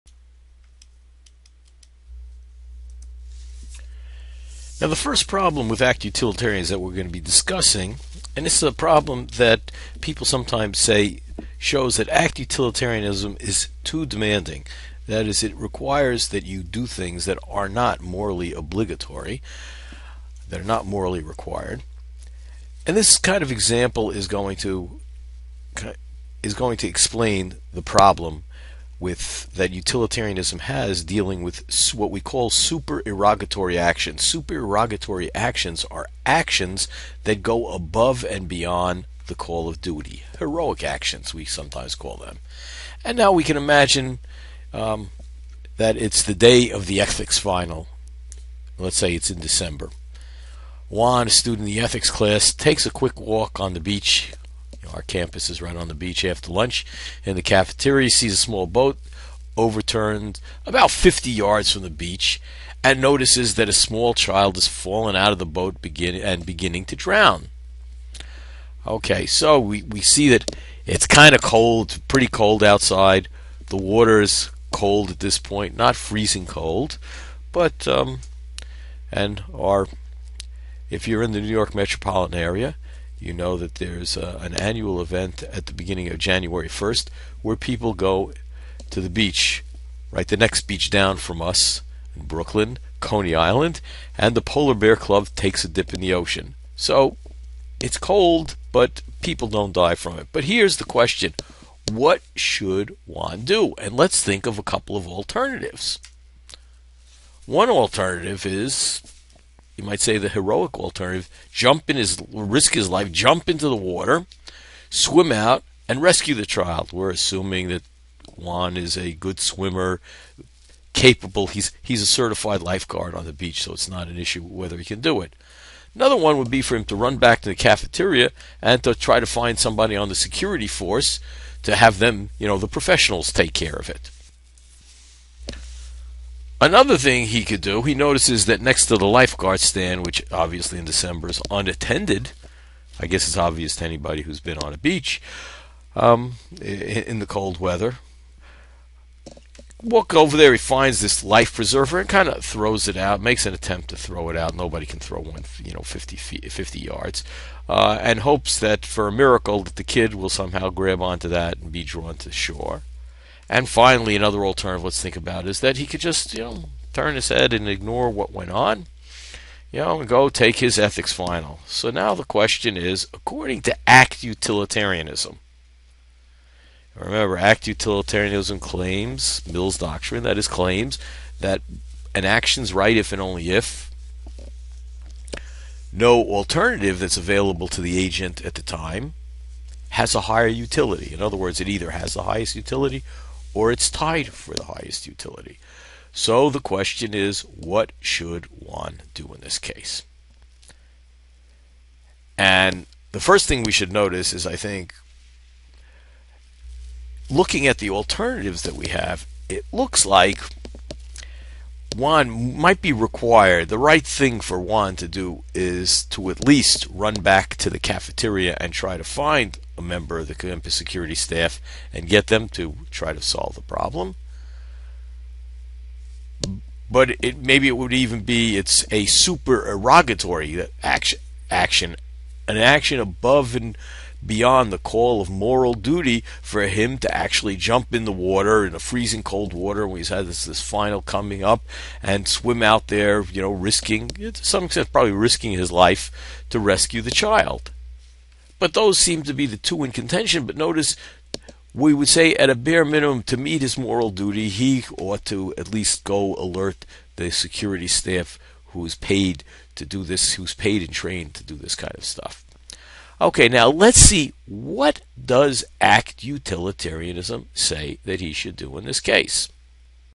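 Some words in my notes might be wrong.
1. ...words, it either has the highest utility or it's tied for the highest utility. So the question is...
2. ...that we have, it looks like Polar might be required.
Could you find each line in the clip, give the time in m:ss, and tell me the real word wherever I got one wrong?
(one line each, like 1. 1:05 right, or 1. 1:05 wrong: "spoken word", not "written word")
1. 3:11 right
2. 3:28 wrong: "Juan", not "Polar".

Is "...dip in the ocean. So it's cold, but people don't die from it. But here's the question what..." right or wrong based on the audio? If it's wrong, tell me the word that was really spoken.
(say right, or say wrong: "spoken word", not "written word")
right.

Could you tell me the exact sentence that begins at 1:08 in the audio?
Okay, so we, we see that it's kind of cold, pretty cold outside.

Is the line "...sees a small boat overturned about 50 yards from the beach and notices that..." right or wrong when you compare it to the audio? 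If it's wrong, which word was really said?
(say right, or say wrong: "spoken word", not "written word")
right.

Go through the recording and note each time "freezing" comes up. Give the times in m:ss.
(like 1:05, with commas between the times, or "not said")
1:15, 3:58.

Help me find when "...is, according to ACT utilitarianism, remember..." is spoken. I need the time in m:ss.
2:52.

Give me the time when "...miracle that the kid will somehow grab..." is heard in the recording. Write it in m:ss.
2:39.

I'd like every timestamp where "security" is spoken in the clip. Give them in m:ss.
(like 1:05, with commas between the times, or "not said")
2:10, 3:40, 4:17.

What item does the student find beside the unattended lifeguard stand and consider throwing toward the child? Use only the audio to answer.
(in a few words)
life preserver.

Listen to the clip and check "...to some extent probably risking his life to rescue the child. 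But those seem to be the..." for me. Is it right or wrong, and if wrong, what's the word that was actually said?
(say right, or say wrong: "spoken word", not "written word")
right.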